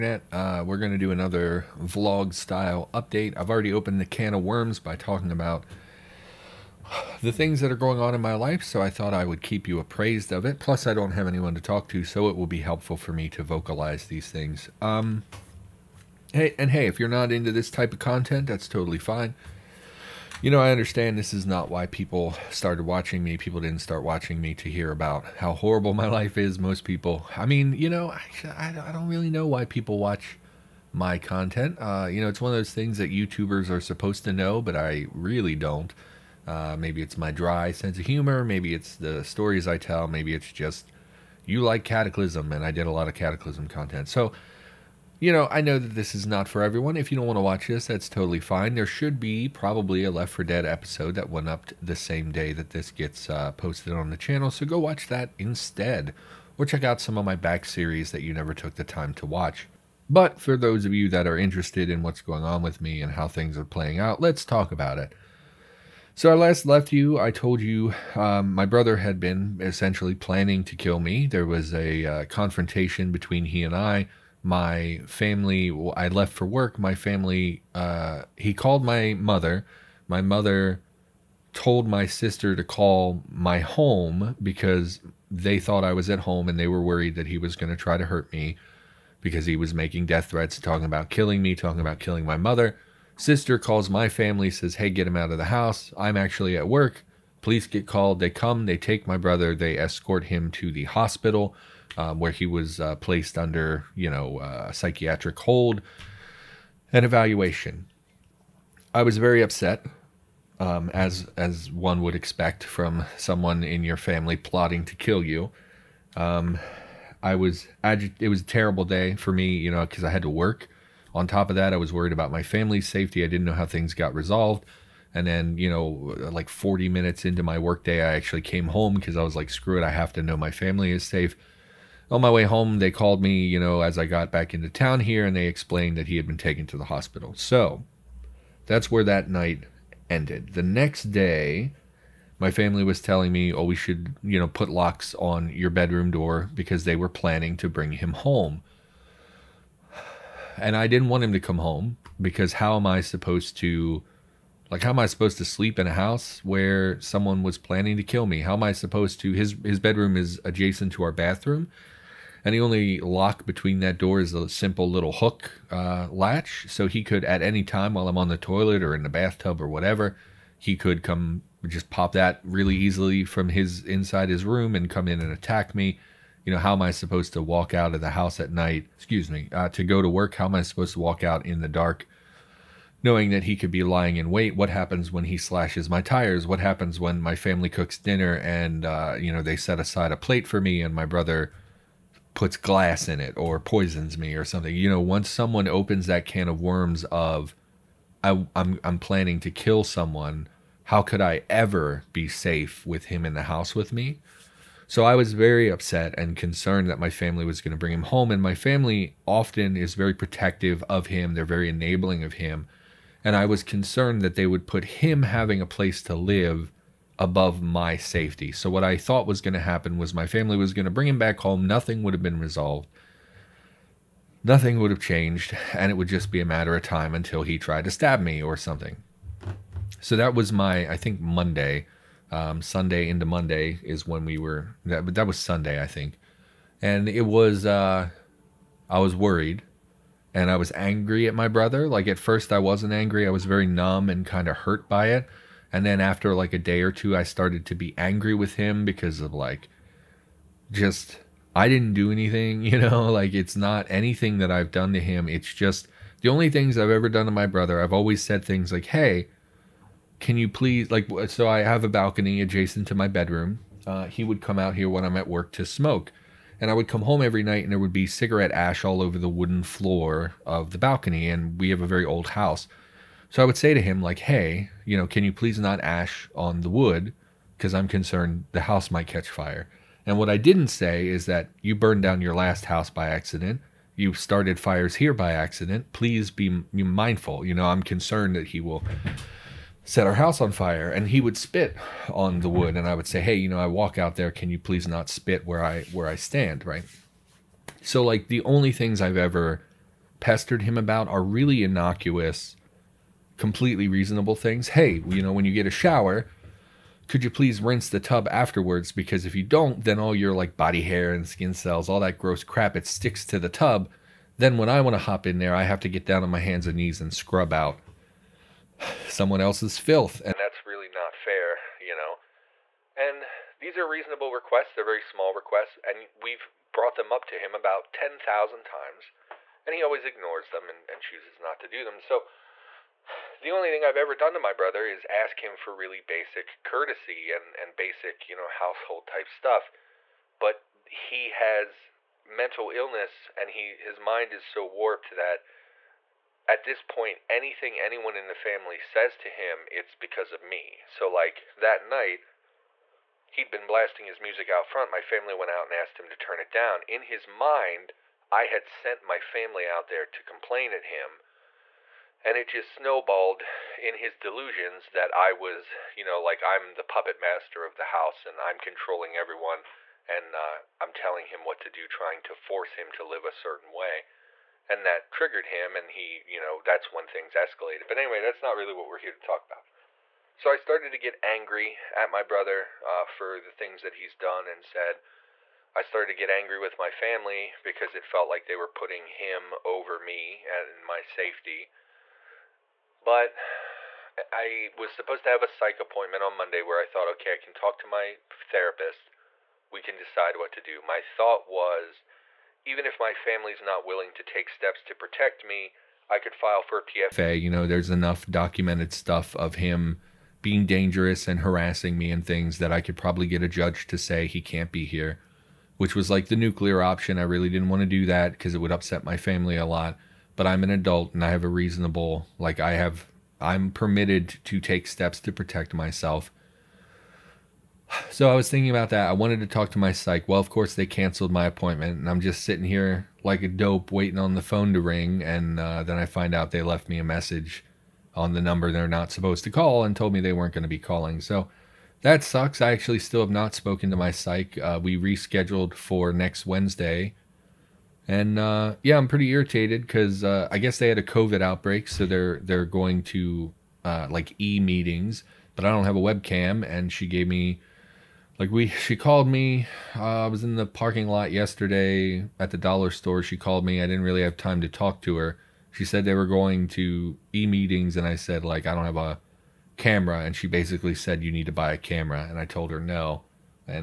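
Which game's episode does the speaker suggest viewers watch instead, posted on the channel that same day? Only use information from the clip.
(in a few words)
Left 4 Dead.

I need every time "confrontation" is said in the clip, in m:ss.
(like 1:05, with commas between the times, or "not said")
1:12.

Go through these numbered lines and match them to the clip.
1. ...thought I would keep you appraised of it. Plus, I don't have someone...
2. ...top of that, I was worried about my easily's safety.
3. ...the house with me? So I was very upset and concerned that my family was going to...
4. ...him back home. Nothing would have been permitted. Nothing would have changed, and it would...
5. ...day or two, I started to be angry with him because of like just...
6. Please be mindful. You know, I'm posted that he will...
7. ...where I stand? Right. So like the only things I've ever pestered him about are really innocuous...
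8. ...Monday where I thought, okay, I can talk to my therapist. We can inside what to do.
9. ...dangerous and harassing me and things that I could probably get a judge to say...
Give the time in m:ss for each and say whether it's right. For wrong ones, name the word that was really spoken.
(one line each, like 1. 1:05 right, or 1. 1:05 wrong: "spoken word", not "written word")
1. 0:08 wrong: "anyone", not "someone"
2. 2:01 wrong: "family", not "easily"
3. 3:23 right
4. 3:41 wrong: "resolved", not "permitted"
5. 4:06 right
6. 4:45 wrong: "concerned", not "posted"
7. 4:55 right
8. 6:36 wrong: "decide", not "inside"
9. 6:50 right.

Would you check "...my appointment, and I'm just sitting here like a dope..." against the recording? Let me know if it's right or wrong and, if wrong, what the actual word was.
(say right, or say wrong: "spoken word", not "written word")
right.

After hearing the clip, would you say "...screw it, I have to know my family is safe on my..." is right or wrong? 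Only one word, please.
right.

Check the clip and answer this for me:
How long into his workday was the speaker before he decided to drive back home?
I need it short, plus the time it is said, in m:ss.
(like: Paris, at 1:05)
40 minutes, at 2:06.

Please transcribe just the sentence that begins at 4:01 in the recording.
Like at first, I wasn't angry.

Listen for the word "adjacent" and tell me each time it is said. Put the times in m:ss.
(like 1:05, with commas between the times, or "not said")
2:40, 4:22.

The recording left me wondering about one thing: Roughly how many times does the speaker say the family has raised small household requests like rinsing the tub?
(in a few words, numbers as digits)
10,000.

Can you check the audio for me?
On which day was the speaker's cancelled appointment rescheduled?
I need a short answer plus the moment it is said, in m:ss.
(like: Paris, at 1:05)
Next Wednesday, at 7:26.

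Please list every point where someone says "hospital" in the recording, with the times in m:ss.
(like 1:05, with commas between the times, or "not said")
1:40, 2:16.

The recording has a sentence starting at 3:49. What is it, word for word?
So that was my, I think, Monday, um, Sunday into Monday is when we were.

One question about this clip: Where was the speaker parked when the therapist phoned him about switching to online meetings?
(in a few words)
The dollar store.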